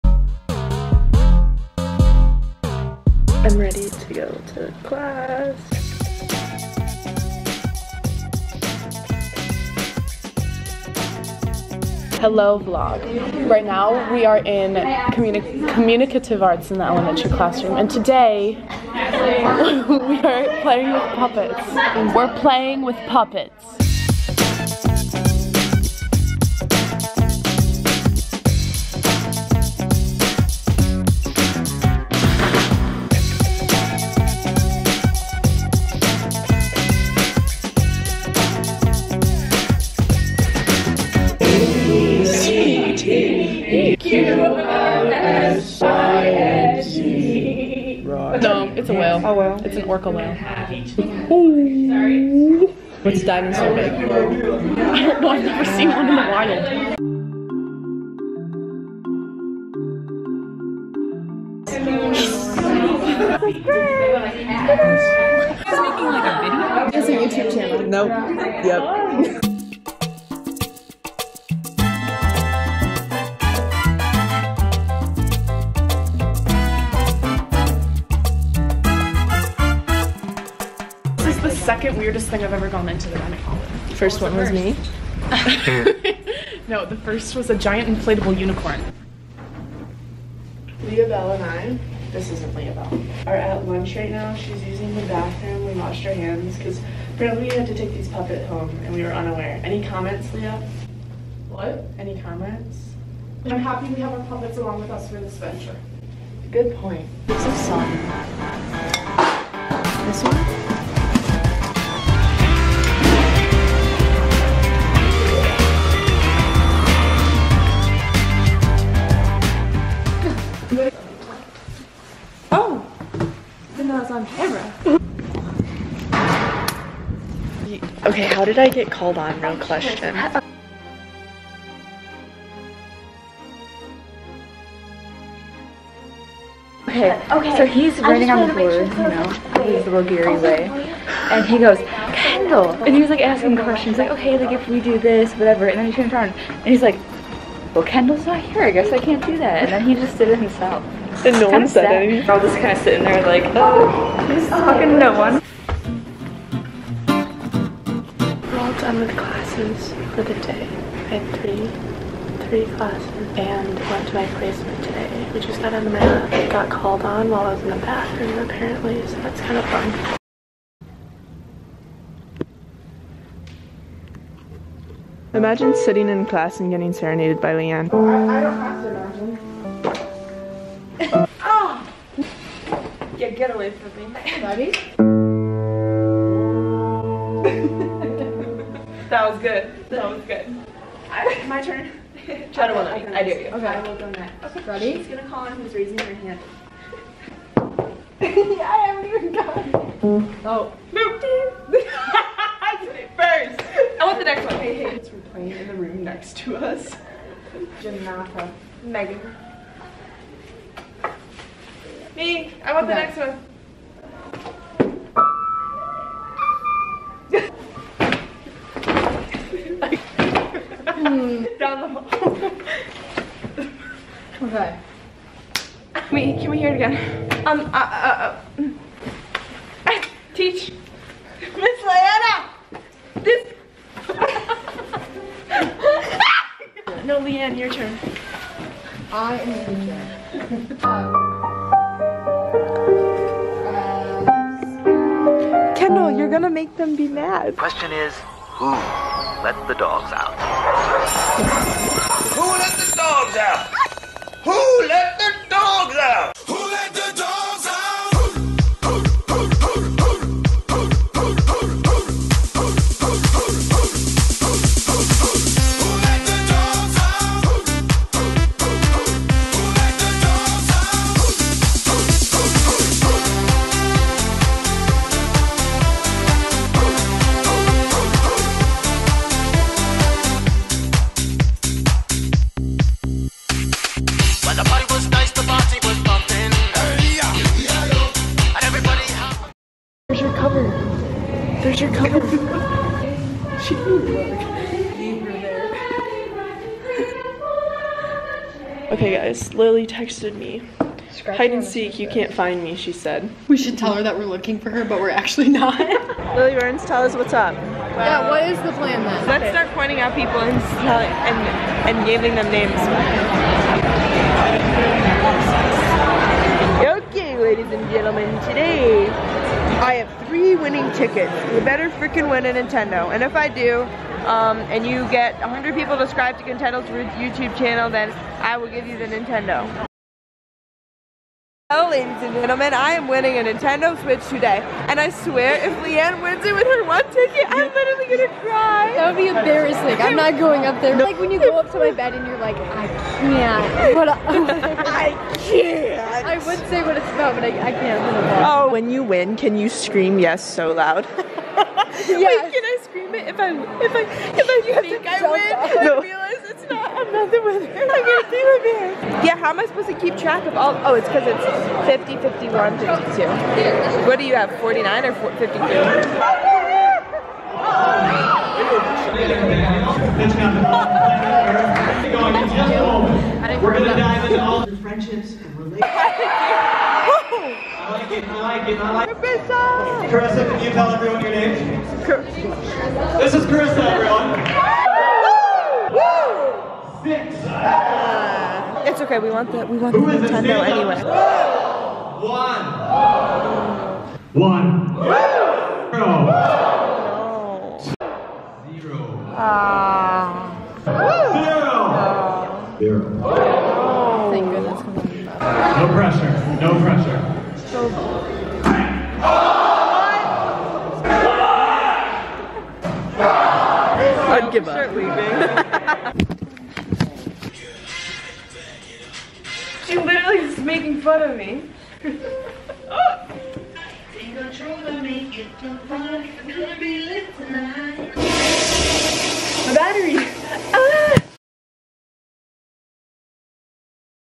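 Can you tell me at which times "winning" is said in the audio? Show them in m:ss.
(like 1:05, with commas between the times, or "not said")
5:20, 5:33.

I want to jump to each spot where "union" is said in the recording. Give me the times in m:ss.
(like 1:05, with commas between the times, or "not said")
not said.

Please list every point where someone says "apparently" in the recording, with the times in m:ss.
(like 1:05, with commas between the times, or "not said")
1:37, 2:48.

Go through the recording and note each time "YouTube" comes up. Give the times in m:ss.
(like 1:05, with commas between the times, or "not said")
1:07, 5:27.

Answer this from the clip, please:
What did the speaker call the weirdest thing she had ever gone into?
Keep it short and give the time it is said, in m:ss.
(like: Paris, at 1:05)
Giant inflatable unicorn, at 1:27.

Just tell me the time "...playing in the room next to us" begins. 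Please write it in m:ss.
3:25.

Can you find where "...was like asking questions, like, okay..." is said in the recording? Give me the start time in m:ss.
2:23.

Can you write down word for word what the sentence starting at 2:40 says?
I had three, three classes and went to my placement today.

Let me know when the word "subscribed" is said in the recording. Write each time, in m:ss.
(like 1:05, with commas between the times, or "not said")
5:25.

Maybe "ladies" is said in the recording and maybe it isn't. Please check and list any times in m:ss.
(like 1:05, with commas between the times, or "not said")
5:17, 5:31.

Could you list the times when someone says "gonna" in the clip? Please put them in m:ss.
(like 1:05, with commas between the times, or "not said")
3:15, 4:06, 5:38, 5:57, 6:13.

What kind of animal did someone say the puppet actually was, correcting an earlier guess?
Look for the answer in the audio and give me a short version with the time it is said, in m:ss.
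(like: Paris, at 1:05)
Orca whale, at 0:49.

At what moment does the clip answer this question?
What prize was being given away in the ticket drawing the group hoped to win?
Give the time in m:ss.
5:33.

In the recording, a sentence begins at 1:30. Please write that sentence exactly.
Leah Bell and I, this isn't Leah Bell, are at lunch right now.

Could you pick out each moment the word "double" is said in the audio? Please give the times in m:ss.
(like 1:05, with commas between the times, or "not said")
not said.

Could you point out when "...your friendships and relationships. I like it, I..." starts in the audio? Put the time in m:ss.
6:14.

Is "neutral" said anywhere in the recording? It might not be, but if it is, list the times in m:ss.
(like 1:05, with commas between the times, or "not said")
not said.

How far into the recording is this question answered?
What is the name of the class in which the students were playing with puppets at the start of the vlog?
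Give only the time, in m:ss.
0:15.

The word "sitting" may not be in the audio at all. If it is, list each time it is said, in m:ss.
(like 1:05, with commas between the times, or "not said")
2:32, 2:55.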